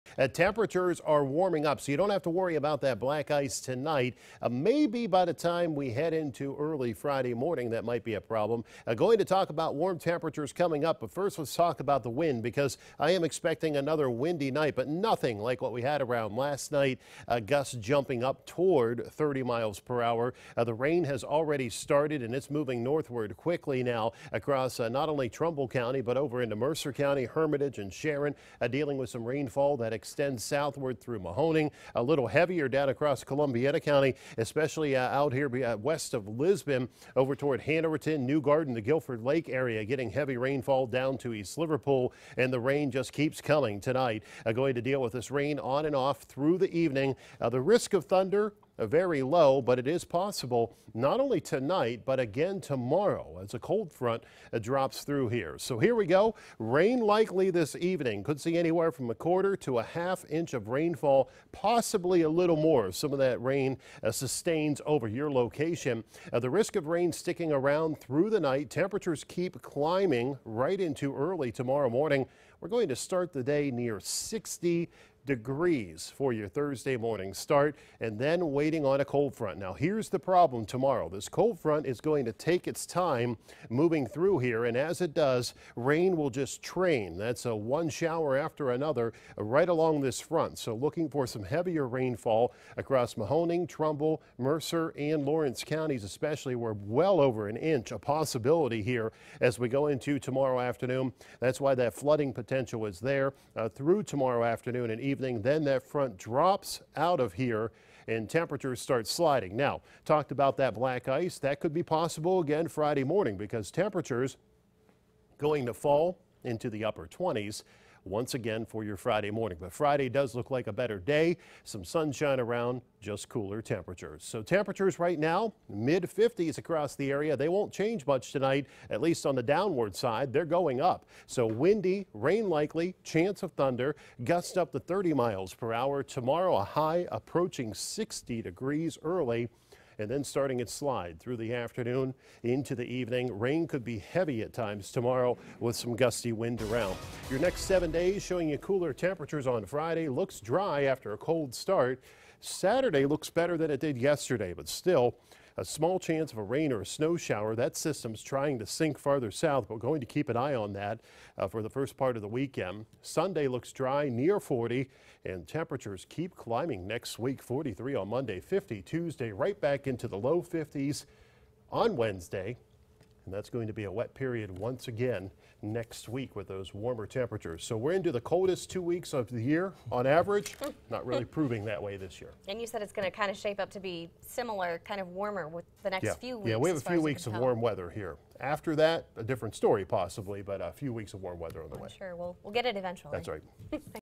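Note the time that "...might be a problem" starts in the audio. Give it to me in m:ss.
0:07.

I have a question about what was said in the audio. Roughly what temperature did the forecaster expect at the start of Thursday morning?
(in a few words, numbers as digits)
60 degrees.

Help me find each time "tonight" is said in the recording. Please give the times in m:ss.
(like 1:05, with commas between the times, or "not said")
0:03, 0:43, 0:51, 2:08.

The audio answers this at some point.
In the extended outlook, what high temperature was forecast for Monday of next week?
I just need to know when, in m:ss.
2:47.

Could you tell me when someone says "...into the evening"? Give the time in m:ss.
2:22.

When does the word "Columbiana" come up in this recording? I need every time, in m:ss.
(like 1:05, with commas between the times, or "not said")
0:33.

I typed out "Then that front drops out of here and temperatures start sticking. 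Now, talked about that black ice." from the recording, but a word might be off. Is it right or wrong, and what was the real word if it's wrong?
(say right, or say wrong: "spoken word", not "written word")
wrong: "sliding", not "sticking".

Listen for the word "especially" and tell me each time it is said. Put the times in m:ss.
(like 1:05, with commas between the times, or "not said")
0:34, 1:36.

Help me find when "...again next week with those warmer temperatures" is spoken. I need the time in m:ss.
2:54.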